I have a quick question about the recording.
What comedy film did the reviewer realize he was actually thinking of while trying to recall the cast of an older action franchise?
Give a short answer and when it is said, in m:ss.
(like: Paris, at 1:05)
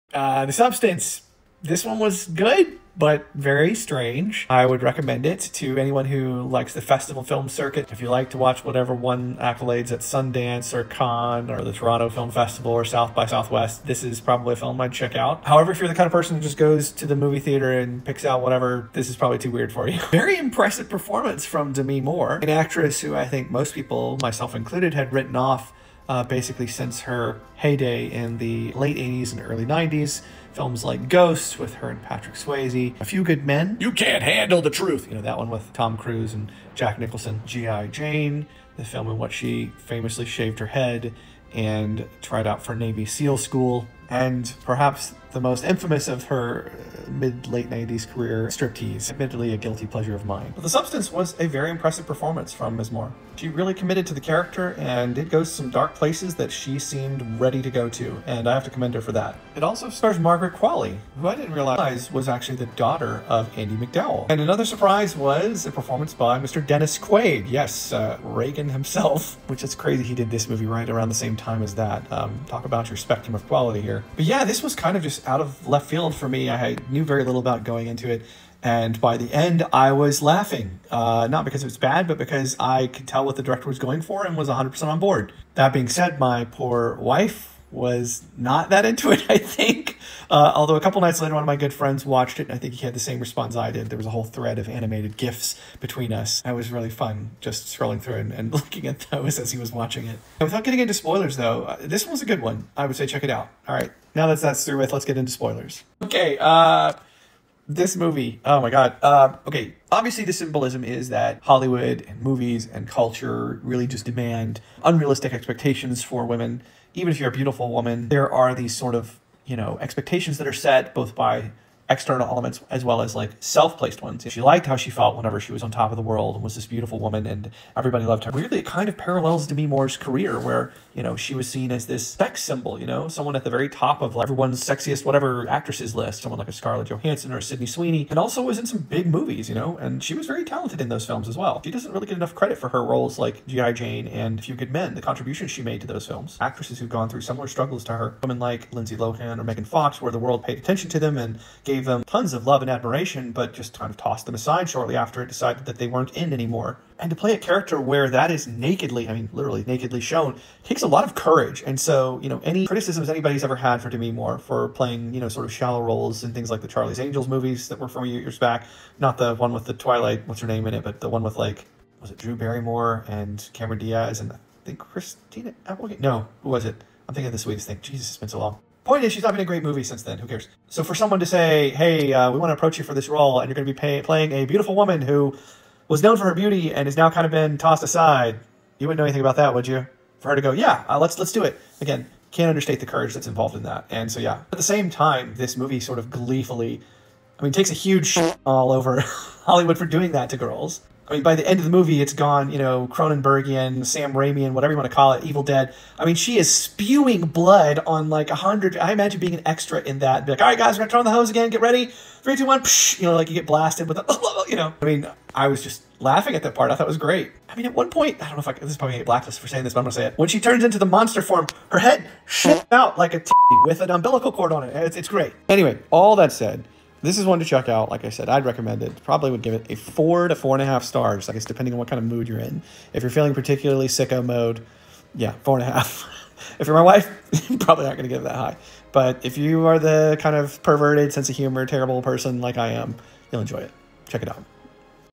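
The Sweetest Thing, at 2:57.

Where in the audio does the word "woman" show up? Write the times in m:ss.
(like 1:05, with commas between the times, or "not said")
1:57, 2:06, 3:04.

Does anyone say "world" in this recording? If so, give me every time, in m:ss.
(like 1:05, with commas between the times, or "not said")
2:06, 2:30.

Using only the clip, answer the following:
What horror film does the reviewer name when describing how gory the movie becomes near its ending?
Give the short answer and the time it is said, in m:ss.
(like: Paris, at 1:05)
Evil Dead, at 3:25.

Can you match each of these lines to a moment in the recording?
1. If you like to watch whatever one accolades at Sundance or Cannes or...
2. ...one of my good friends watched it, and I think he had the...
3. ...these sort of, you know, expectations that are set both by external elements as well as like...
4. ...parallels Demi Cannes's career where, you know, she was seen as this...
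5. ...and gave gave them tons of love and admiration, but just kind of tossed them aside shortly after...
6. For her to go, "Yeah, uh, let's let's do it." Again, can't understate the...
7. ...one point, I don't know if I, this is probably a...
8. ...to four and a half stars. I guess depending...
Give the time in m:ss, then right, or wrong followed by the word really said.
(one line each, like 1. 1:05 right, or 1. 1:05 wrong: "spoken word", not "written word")
1. 0:07 right
2. 1:31 right
3. 1:58 right
4. 2:08 wrong: "Moore", not "Cannes"
5. 2:31 right
6. 3:10 right
7. 3:37 right
8. 3:50 right.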